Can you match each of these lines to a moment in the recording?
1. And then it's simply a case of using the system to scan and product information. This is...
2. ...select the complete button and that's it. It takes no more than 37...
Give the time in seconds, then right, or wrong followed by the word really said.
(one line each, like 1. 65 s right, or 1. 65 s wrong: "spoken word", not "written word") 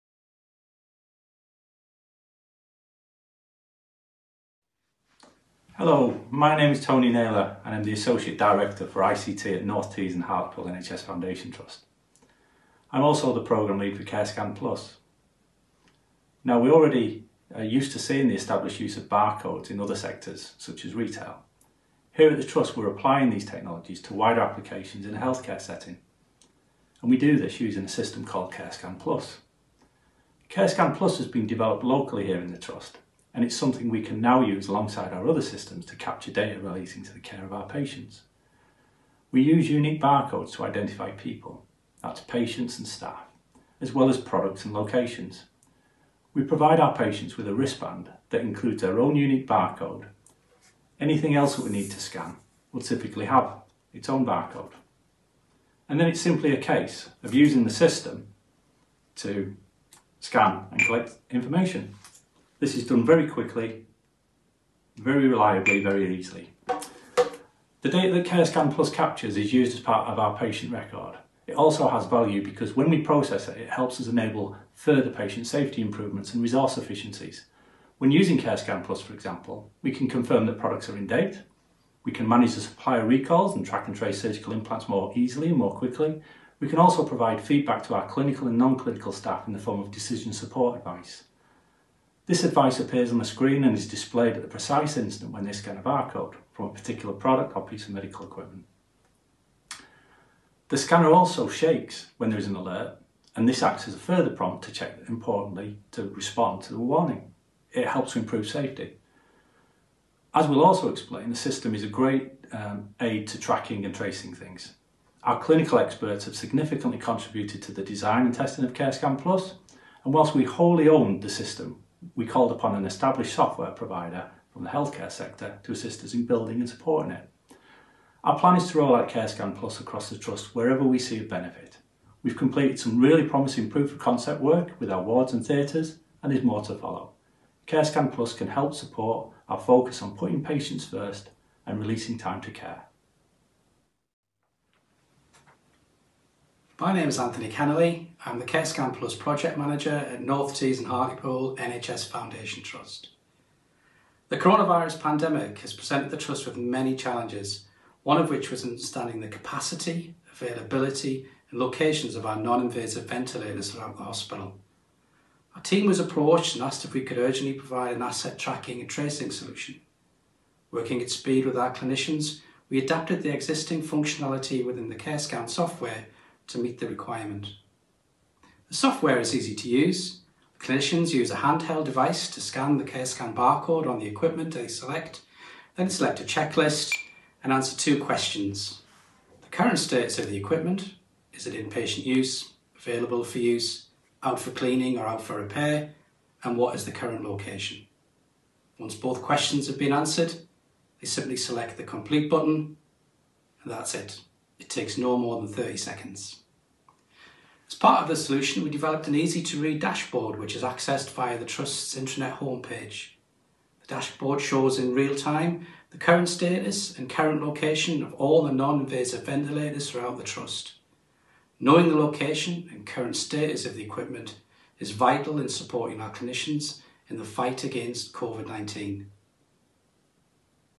1. 55 s wrong: "collect", not "product"
2. 201 s wrong: "30", not "37".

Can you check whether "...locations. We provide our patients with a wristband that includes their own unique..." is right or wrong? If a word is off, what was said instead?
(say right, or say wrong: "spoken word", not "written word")
right.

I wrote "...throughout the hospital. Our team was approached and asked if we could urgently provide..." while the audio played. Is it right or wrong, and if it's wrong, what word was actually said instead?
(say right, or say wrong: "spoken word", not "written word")
right.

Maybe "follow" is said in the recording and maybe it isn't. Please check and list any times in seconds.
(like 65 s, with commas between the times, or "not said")
136 s.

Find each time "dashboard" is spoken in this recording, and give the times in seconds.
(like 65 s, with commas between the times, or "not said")
209 s, 213 s.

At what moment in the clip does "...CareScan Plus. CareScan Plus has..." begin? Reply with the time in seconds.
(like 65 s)
28 s.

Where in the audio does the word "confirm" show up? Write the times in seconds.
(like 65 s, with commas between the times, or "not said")
80 s.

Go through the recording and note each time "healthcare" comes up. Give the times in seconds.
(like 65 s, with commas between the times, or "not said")
25 s, 124 s.